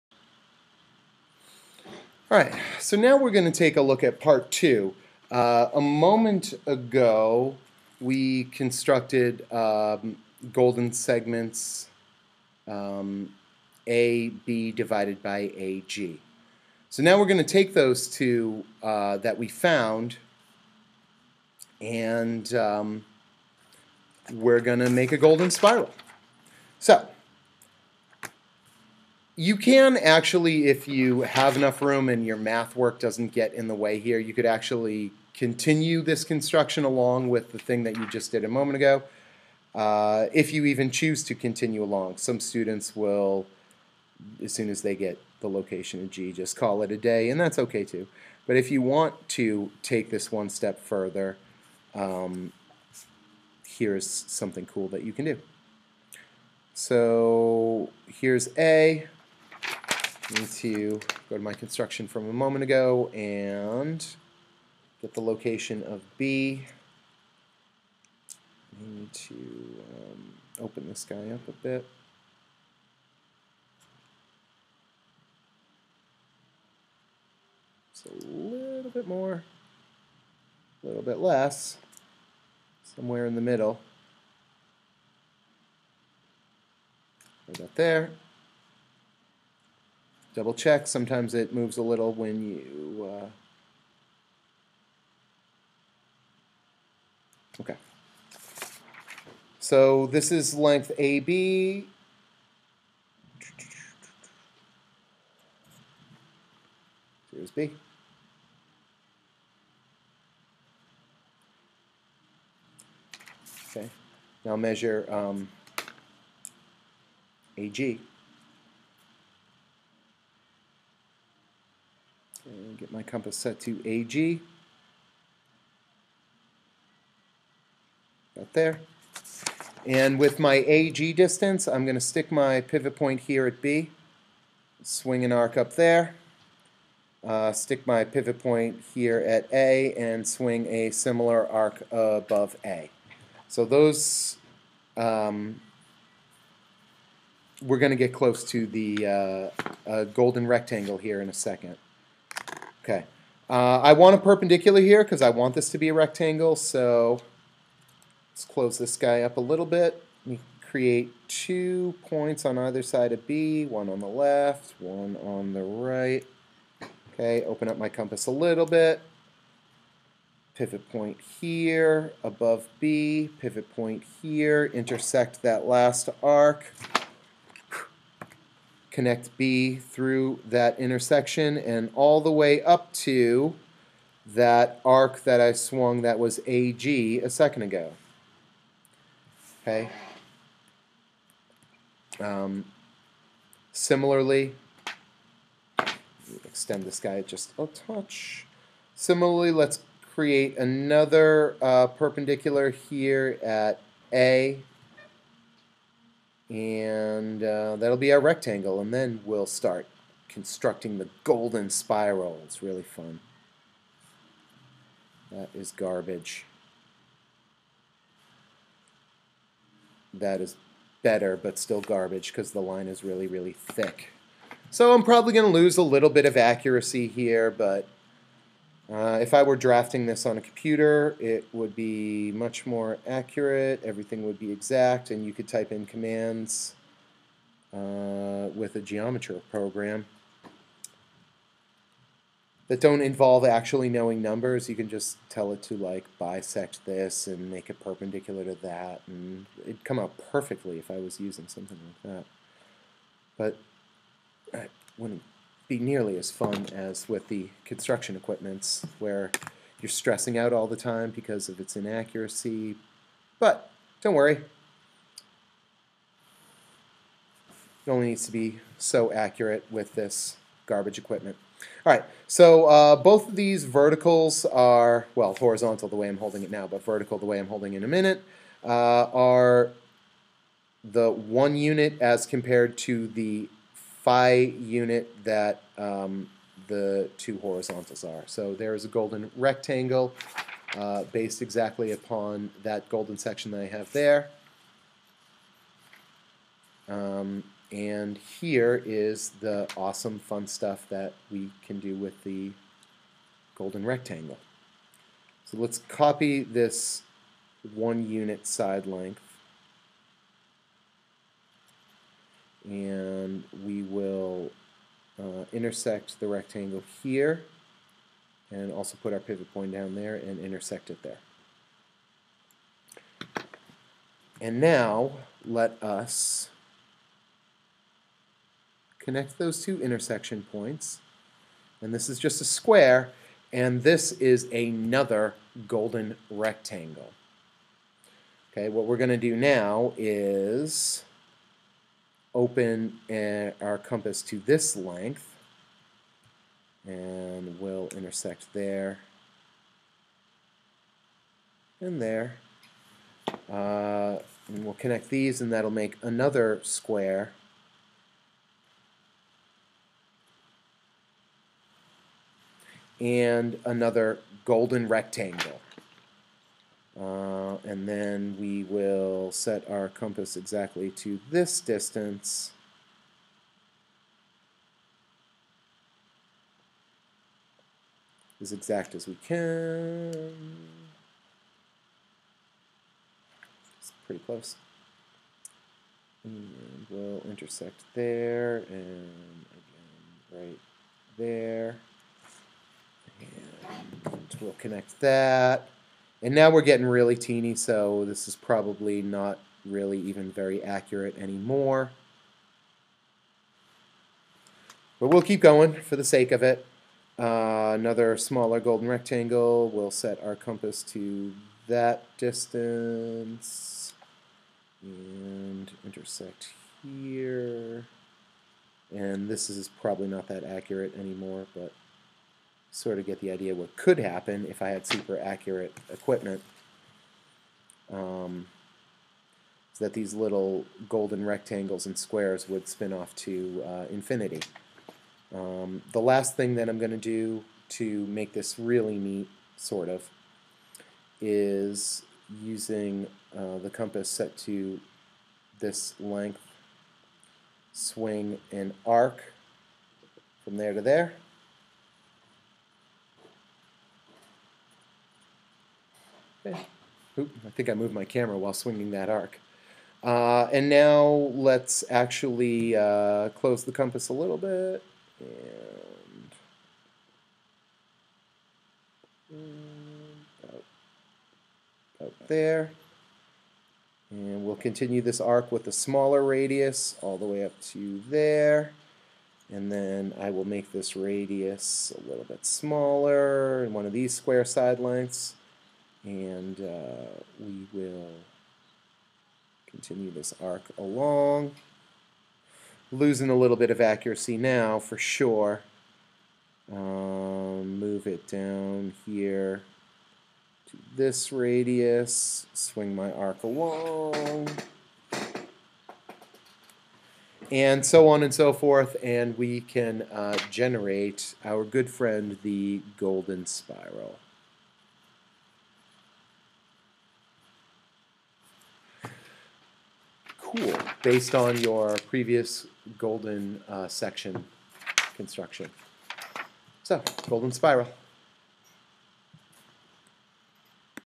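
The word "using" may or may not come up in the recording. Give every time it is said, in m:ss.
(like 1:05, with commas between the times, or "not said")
4:11, 7:22.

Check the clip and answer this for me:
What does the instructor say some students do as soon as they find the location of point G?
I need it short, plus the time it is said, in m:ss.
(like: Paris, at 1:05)
call it a day, at 0:46.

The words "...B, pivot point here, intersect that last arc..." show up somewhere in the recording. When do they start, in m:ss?
2:52.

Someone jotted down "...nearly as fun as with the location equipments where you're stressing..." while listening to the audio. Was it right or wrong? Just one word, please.
wrong.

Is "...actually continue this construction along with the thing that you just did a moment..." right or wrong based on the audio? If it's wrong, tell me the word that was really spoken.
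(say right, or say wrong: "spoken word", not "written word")
right.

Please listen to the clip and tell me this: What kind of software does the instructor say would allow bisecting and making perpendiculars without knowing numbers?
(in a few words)
geometry program.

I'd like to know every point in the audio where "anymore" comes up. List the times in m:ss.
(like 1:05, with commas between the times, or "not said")
6:41, 7:00.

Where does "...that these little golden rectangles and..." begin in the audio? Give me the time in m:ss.
7:09.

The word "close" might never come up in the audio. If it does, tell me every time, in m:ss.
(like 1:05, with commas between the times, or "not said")
2:28, 2:38, 6:24, 7:43.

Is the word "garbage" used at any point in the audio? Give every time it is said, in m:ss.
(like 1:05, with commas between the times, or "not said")
3:35, 3:41, 4:30.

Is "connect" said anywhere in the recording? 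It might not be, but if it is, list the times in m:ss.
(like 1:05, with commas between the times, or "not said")
2:58, 5:28, 5:54, 6:34.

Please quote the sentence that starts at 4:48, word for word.
So there is a golden rectangle uh, based exactly upon that golden section that I have there.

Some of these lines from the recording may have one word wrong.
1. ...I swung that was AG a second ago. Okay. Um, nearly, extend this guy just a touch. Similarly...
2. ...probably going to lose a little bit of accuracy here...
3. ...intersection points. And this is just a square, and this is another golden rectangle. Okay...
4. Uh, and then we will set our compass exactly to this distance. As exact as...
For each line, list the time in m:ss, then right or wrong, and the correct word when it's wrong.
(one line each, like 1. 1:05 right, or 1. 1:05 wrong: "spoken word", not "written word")
1. 3:05 wrong: "similarly", not "nearly"
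2. 3:45 right
3. 5:29 right
4. 6:06 right.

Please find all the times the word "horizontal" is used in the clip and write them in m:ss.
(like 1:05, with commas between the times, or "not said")
4:35, 4:47.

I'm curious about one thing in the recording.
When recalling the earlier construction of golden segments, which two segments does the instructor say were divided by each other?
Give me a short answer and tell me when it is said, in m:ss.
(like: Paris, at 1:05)
AB divided by AG, at 0:13.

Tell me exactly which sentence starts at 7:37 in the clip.
oop, I think I moved my camera while swinging that arc.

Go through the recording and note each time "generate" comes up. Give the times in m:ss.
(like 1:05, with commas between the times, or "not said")
8:30.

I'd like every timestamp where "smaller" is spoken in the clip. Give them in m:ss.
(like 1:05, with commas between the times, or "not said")
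6:48, 7:55, 8:02.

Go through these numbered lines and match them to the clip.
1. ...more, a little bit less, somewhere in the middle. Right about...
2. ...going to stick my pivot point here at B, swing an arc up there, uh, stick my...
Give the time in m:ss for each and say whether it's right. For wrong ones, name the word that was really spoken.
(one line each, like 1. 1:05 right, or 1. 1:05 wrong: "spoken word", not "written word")
1. 1:19 right
2. 2:11 right.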